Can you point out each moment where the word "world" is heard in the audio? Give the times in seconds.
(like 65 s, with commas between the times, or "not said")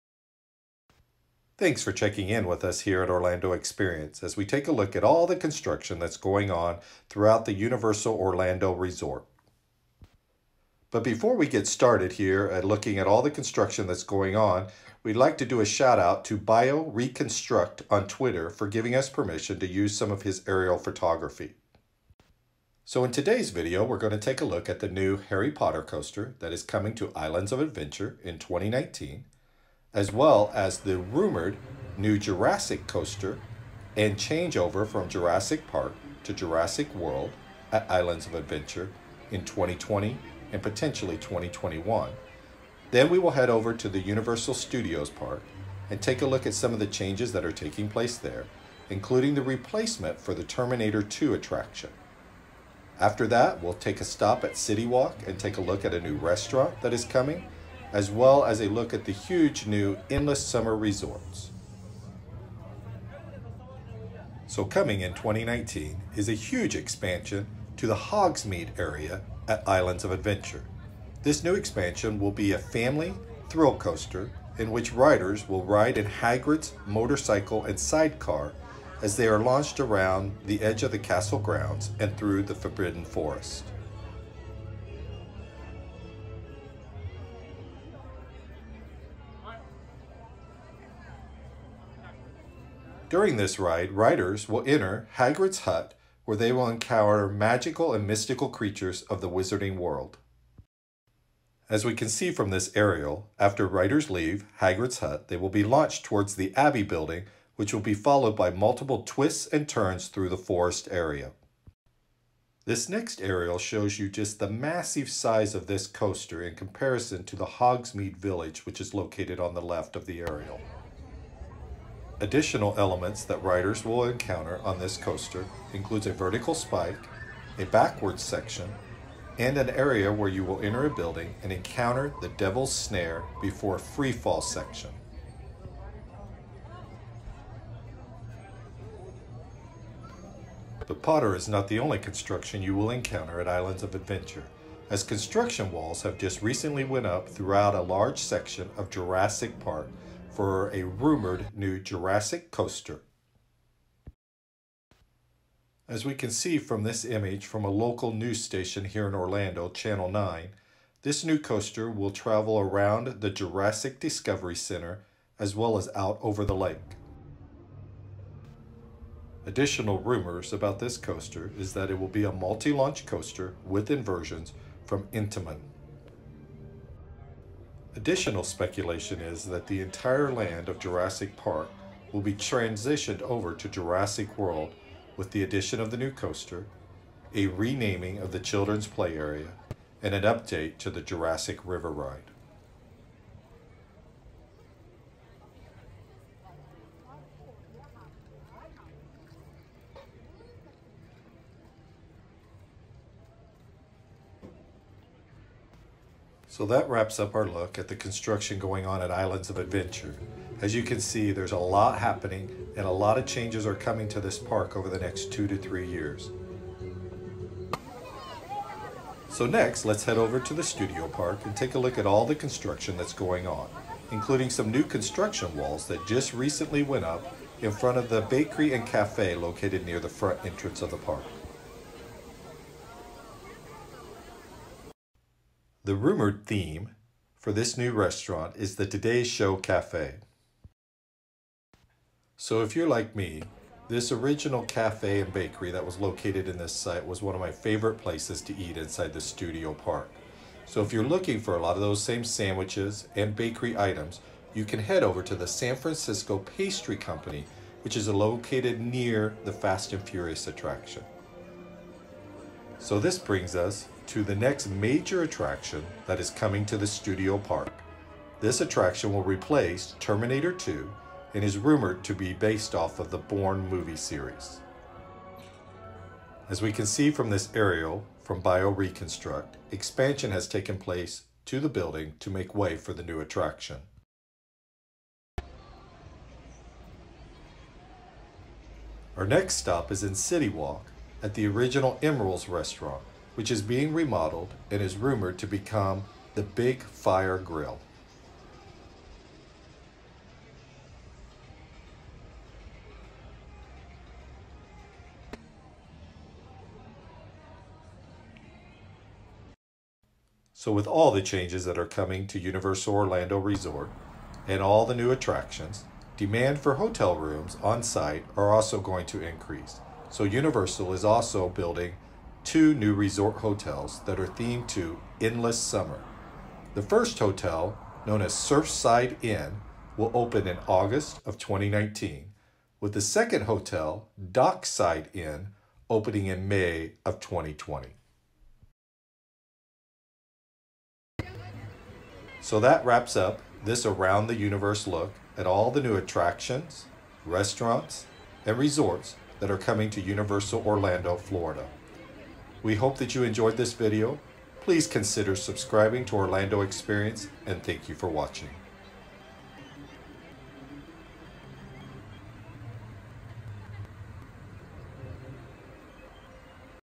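36 s, 99 s, 184 s.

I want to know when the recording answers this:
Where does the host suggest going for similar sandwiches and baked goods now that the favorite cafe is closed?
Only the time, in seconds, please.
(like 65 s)
255 s.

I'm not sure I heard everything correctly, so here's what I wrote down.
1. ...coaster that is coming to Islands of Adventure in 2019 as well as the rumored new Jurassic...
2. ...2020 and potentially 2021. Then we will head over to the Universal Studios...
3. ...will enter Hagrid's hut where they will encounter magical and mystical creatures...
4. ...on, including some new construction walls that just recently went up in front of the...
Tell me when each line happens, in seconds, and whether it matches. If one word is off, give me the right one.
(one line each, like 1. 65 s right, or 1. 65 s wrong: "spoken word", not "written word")
1. 25 s right
2. 39 s right
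3. 94 s right
4. 223 s right.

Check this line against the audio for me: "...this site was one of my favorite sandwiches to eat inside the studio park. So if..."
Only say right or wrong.
wrong.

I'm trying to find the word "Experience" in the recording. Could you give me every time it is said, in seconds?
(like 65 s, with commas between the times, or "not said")
3 s, 356 s.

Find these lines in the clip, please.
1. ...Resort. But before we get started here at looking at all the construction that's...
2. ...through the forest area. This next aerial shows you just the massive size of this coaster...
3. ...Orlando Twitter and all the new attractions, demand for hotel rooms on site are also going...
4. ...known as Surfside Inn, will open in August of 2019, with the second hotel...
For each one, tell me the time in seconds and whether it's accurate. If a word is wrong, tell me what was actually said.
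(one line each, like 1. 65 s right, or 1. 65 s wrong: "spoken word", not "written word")
1. 8 s right
2. 110 s right
3. 312 s wrong: "Resort", not "Twitter"
4. 328 s right.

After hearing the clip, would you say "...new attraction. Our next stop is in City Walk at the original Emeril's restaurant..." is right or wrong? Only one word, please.
right.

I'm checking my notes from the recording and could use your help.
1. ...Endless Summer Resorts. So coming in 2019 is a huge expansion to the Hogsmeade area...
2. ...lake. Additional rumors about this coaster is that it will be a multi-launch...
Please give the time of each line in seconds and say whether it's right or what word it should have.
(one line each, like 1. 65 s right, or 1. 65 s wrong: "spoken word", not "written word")
1. 60 s right
2. 166 s right.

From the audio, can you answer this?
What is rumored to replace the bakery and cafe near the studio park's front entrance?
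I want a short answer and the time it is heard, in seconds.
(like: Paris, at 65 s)
Today Show Cafe, at 238 s.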